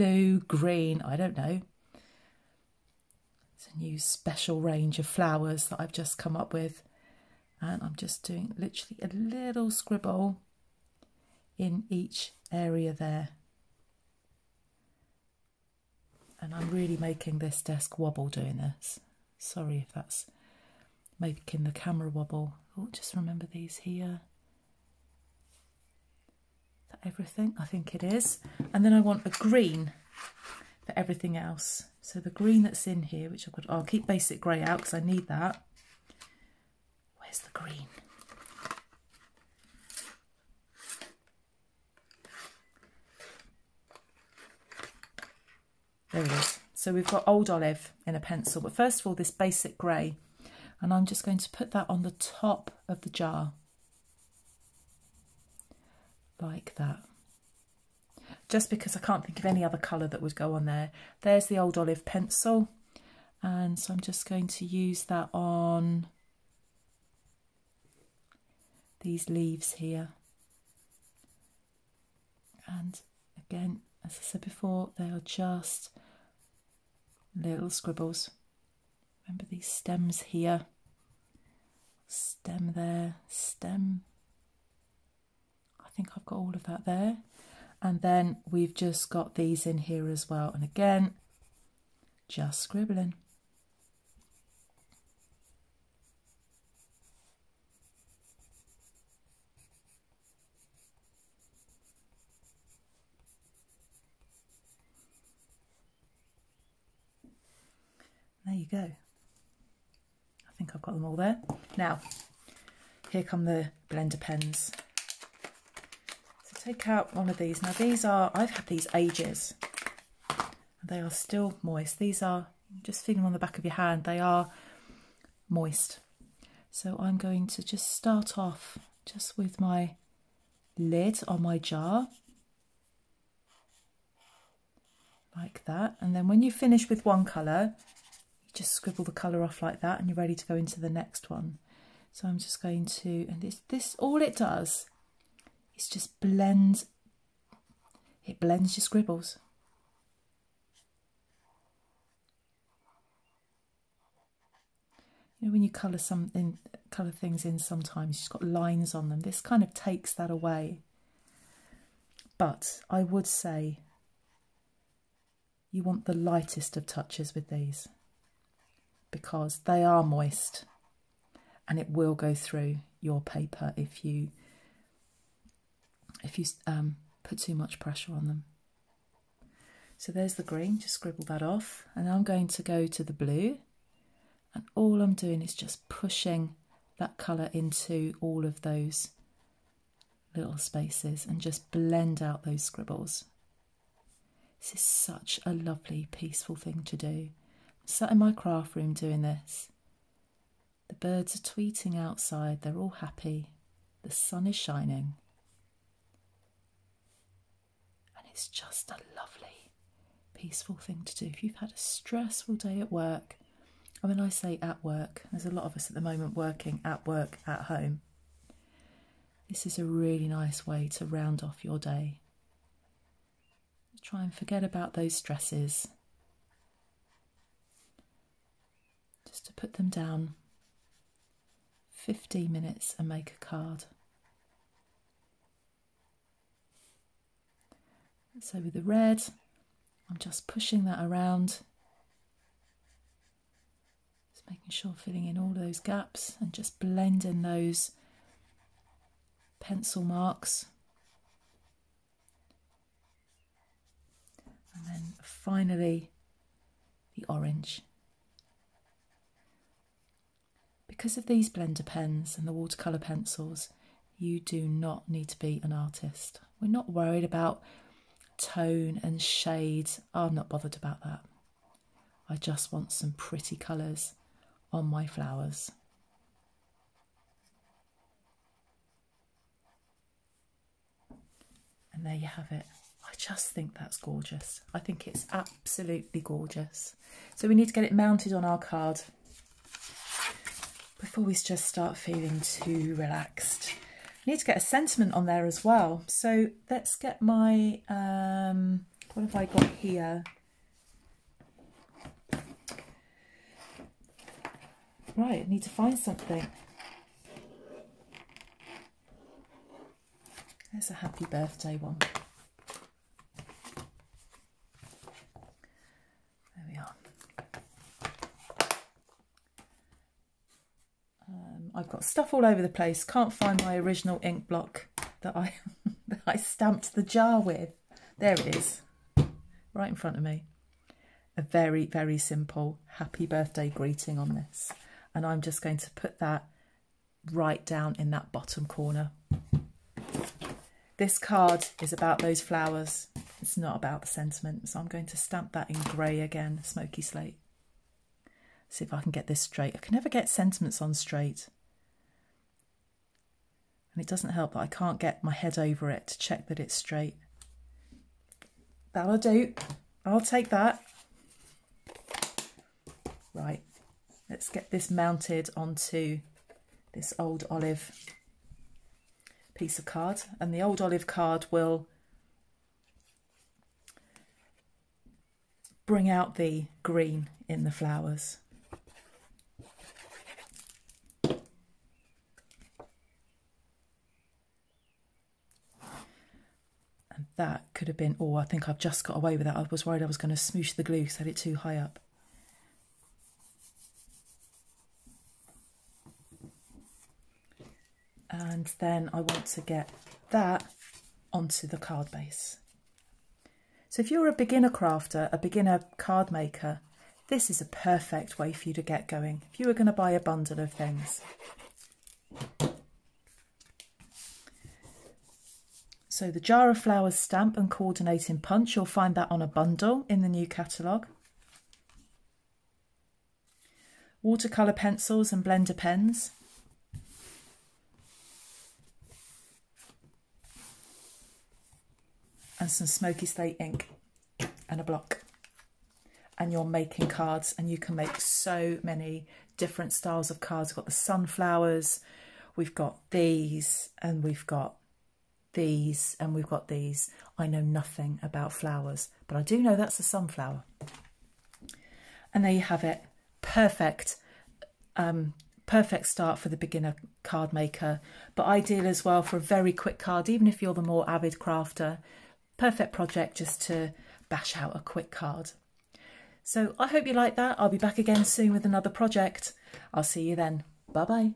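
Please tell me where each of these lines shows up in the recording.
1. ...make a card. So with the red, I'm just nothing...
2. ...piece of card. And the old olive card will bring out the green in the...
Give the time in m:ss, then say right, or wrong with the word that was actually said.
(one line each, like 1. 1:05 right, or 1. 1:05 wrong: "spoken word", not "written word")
1. 3:53 wrong: "pushing", not "nothing"
2. 6:09 right.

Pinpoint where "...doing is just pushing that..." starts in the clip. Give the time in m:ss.
3:05.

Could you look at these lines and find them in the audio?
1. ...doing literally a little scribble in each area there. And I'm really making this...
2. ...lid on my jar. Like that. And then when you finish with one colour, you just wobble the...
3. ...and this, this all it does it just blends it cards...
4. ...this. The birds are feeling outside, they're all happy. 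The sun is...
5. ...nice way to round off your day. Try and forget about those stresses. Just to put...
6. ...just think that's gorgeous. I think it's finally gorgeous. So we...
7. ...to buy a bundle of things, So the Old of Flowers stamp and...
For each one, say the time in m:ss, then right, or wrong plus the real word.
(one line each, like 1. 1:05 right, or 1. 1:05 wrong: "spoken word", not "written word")
1. 0:08 right
2. 2:10 wrong: "scribble", not "wobble"
3. 2:23 wrong: "blends", not "cards"
4. 3:19 wrong: "tweeting", not "feeling"
5. 3:40 right
6. 4:43 wrong: "absolutely", not "finally"
7. 6:49 wrong: "Jar", not "Old".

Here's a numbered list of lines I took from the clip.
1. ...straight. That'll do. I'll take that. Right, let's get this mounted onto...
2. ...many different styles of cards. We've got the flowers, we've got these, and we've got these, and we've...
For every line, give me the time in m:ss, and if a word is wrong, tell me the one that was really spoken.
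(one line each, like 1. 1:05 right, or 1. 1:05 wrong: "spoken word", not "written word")
1. 5:56 right
2. 7:18 wrong: "sunflowers", not "flowers".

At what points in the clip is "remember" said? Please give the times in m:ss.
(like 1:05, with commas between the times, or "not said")
0:23, 1:19.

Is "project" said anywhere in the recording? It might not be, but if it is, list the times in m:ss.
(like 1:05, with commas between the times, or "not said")
7:42, 7:48.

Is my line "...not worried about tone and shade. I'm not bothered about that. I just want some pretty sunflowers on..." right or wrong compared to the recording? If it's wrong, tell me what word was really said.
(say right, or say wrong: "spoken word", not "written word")
wrong: "colours", not "sunflowers".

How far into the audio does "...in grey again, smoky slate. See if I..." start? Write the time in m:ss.
5:45.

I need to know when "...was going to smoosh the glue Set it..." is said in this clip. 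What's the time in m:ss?
6:30.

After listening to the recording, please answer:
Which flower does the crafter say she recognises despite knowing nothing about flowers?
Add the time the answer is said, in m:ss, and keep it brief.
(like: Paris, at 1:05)
sunflower, at 7:30.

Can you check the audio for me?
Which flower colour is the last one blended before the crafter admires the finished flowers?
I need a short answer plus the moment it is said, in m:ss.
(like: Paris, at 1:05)
orange, at 4:17.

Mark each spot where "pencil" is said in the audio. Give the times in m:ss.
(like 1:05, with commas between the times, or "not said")
0:48, 1:02, 4:09, 4:22, 7:04.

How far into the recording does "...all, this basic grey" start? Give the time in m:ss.
0:49.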